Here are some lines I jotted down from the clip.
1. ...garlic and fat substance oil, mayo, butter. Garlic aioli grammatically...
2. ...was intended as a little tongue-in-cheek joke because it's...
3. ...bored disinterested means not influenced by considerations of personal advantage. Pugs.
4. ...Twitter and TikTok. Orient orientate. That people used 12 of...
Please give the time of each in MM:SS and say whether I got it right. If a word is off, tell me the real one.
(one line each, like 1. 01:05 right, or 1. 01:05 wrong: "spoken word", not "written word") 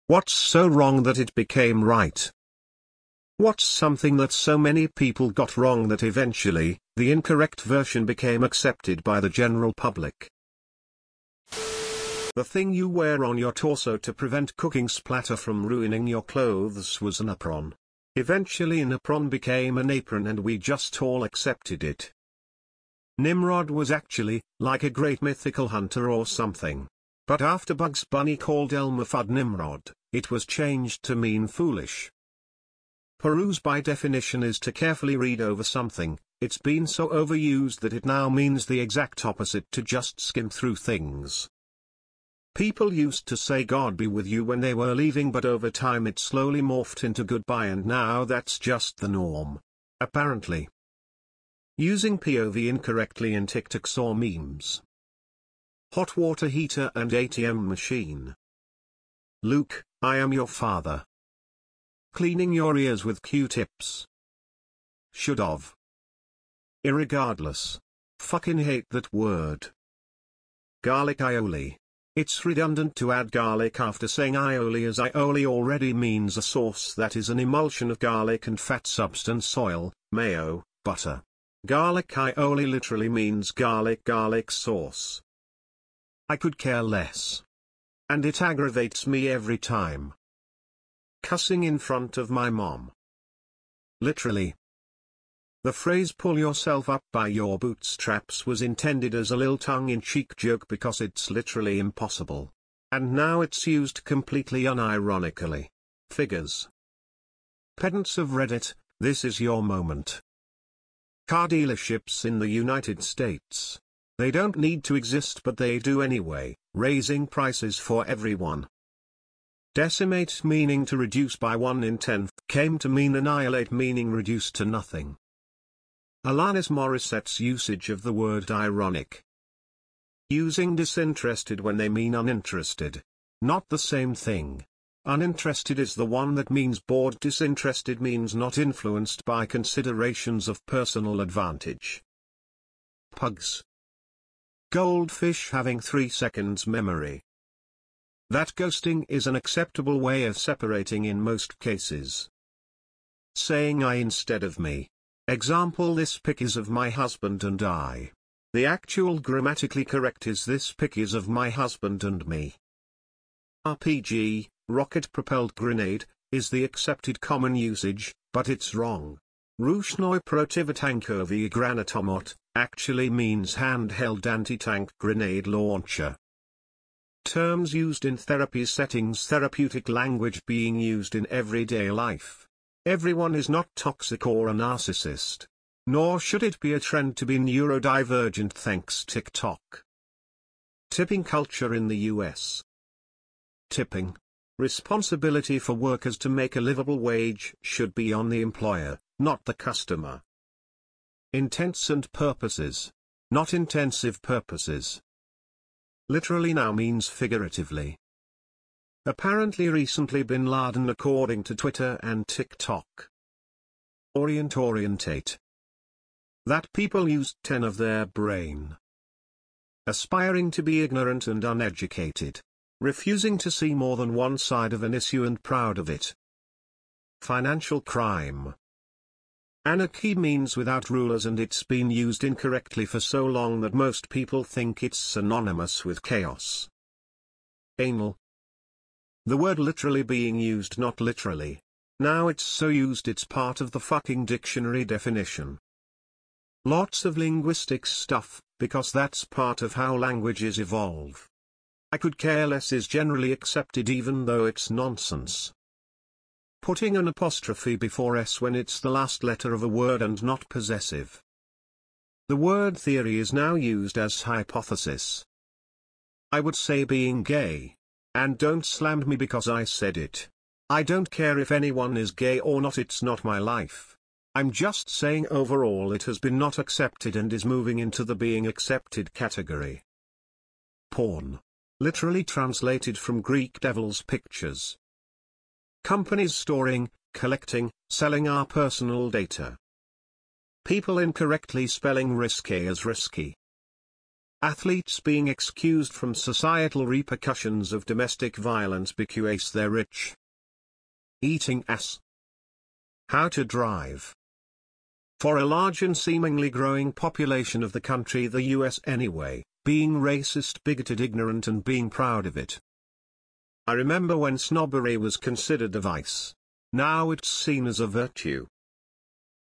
1. 01:17 wrong: "literally", not "grammatically"
2. 01:38 right
3. 02:16 right
4. 03:31 wrong: "10", not "12".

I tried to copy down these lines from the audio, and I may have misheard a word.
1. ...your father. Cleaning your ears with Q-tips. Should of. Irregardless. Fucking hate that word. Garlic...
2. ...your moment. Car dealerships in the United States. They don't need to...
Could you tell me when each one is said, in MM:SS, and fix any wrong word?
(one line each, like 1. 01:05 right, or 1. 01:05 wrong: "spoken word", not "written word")
1. 01:00 right
2. 01:49 right.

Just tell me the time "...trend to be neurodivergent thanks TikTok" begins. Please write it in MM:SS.
03:06.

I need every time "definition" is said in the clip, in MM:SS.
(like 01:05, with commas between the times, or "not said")
00:33, 04:04.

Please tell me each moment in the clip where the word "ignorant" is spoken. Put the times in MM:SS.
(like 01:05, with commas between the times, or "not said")
03:40, 05:11.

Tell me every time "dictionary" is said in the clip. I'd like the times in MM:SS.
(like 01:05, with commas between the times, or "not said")
04:04.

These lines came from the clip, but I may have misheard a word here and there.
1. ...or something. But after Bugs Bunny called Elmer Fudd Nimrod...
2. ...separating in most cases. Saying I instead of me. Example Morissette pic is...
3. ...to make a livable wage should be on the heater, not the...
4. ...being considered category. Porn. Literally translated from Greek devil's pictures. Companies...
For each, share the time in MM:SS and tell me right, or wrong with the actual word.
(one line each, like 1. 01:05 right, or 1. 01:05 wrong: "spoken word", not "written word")
1. 00:26 right
2. 02:30 wrong: "This", not "Morissette"
3. 03:16 wrong: "employer", not "heater"
4. 04:38 wrong: "accepted", not "considered".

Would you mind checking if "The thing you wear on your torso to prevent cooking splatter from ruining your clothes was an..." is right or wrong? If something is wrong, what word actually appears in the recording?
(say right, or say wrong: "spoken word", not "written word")
right.